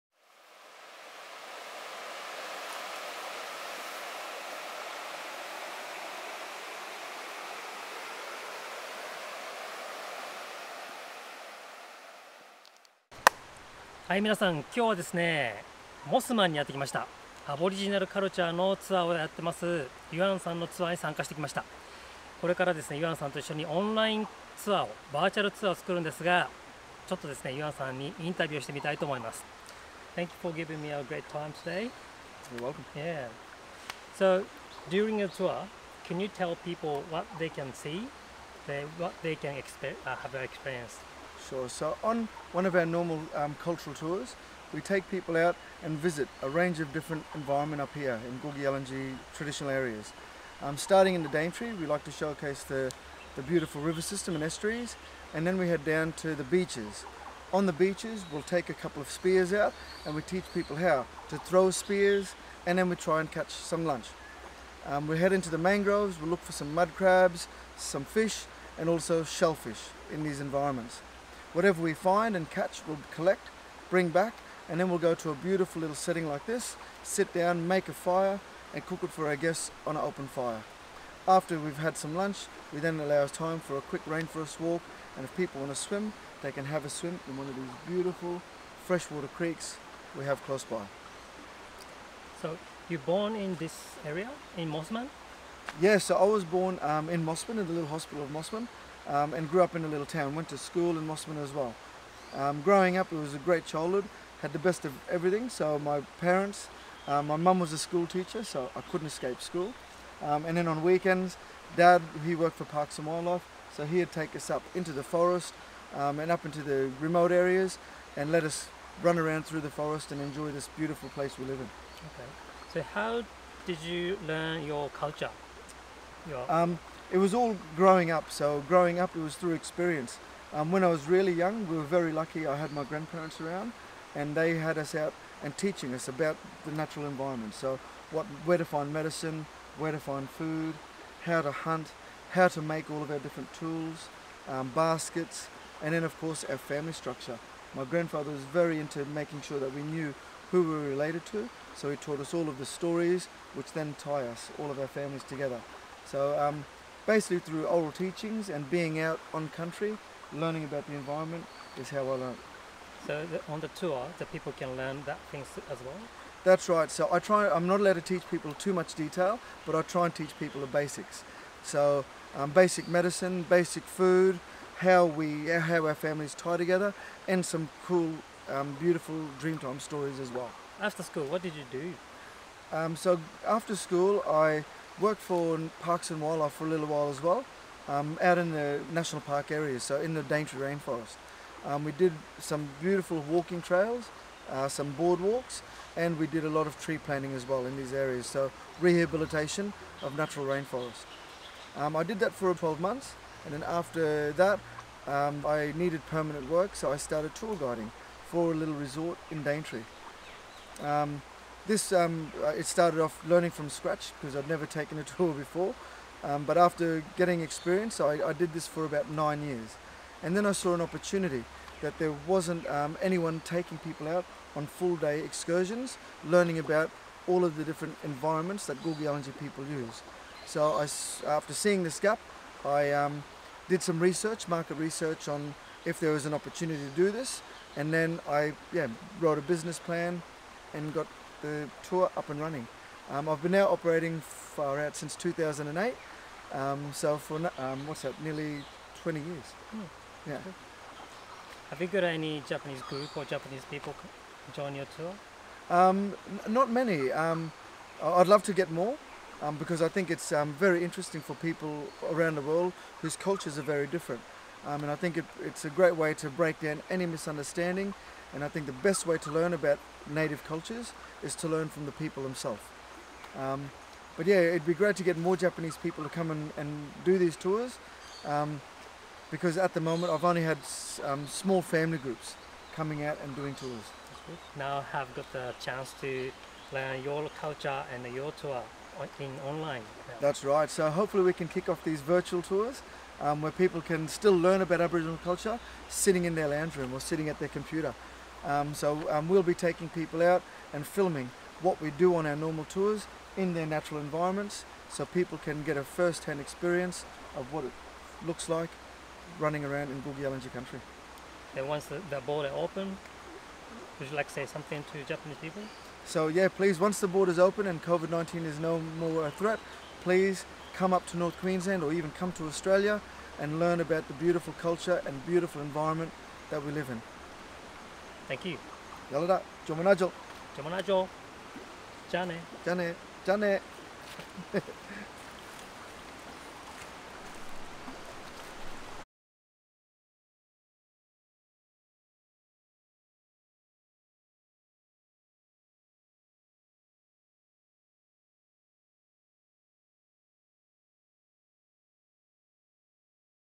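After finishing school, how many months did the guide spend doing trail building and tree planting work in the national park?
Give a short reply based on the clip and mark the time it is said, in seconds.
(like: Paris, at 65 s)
12, at 202 s.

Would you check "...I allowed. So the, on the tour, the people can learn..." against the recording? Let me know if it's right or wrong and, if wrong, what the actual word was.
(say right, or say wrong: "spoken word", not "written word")
wrong: "learned", not "allowed".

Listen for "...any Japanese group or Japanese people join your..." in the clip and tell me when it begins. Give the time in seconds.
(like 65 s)
252 s.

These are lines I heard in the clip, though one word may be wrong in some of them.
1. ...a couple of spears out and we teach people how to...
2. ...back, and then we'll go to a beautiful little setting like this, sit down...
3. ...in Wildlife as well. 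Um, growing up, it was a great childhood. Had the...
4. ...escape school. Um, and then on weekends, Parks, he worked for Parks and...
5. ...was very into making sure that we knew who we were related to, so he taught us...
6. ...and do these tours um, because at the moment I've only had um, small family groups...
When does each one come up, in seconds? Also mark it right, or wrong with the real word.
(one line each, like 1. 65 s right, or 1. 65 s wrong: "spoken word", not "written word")
1. 58 s right
2. 74 s right
3. 100 s wrong: "Mossman", not "Wildlife"
4. 109 s wrong: "Dad", not "Parks"
5. 148 s right
6. 276 s right.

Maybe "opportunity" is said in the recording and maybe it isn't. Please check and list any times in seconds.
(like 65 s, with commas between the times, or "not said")
220 s, 236 s.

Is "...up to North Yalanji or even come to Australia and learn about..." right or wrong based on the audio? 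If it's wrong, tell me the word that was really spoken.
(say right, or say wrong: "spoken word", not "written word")
wrong: "Queensland", not "Yalanji".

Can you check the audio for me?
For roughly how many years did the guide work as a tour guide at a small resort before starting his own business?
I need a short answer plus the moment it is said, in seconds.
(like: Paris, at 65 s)
9, at 219 s.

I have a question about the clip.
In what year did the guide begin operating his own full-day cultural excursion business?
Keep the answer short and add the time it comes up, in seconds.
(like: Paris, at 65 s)
2008, at 245 s.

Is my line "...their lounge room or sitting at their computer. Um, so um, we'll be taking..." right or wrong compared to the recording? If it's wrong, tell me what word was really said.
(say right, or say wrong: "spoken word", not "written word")
right.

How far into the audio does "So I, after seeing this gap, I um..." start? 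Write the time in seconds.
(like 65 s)
230 s.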